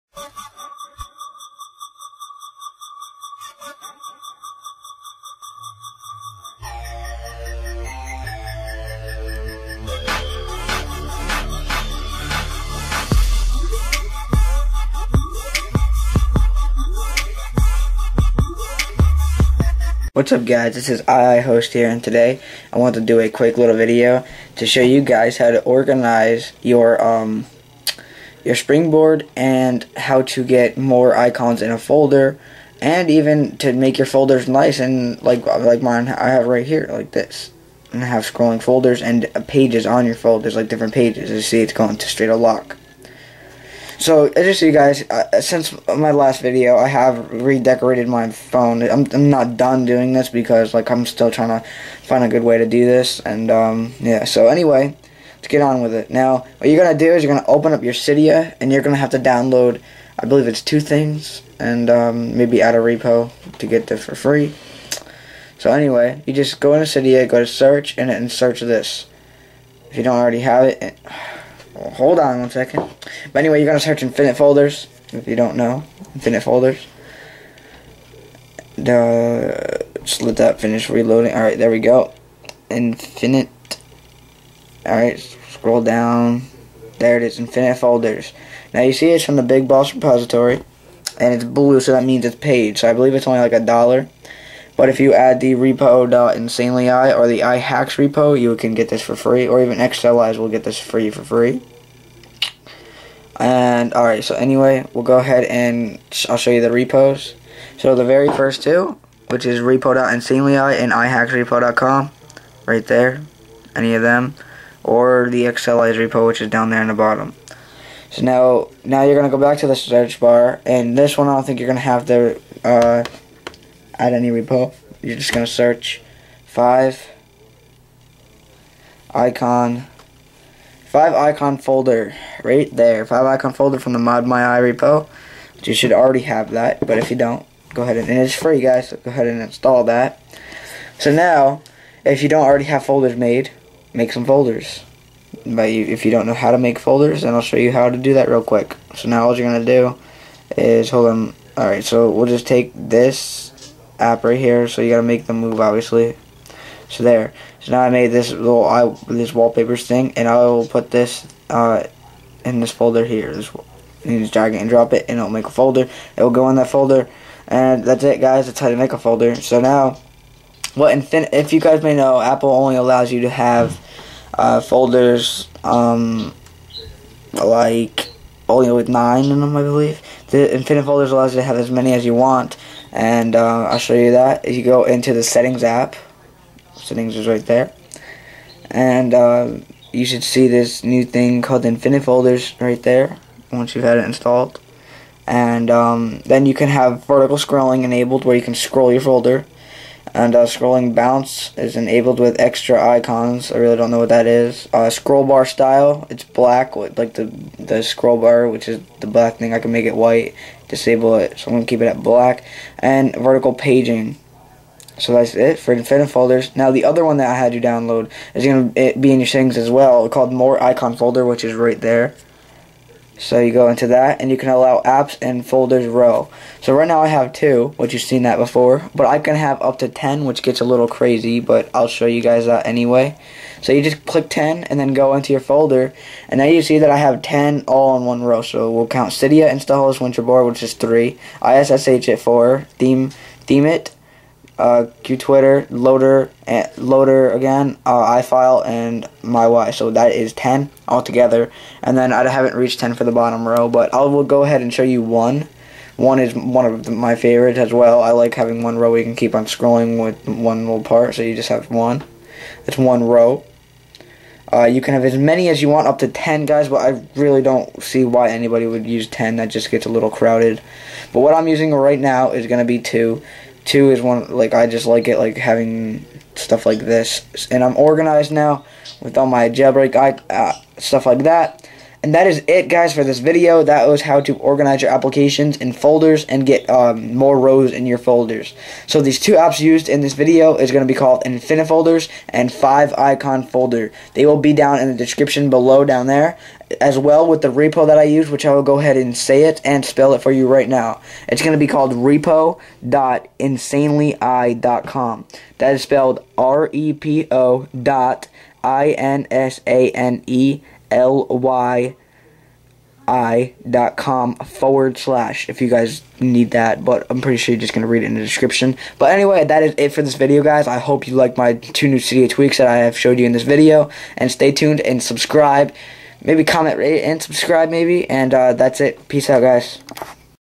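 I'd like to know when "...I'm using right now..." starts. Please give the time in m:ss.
4:31.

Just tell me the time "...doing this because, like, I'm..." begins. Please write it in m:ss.
0:49.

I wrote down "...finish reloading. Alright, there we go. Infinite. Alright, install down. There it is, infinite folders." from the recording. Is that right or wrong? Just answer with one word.
wrong.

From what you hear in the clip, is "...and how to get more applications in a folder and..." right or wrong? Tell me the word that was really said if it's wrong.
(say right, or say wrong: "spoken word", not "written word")
wrong: "icons", not "applications".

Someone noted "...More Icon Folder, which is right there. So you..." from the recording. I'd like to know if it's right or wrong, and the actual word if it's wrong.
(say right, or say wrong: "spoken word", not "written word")
right.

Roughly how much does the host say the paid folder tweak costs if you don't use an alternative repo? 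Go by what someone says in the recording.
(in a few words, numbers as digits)
a dollar.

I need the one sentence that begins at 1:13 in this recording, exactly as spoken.
But anyway, you're going to search infinite folders, if you don't know.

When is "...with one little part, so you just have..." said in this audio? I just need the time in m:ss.
4:20.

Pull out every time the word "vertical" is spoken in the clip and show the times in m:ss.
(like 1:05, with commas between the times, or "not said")
3:17, 3:33.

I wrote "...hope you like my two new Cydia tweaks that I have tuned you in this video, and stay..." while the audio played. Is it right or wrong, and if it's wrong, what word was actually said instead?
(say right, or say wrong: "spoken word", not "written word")
wrong: "showed", not "tuned".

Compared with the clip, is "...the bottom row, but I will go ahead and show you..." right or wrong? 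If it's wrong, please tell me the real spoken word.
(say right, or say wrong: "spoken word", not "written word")
right.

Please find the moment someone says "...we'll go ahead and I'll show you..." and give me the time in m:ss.
1:44.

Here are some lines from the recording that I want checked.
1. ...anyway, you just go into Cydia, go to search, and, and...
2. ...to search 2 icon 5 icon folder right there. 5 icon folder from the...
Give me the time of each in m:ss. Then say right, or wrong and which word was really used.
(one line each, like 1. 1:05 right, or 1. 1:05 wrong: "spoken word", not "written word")
1. 1:05 right
2. 2:05 wrong: "5", not "2".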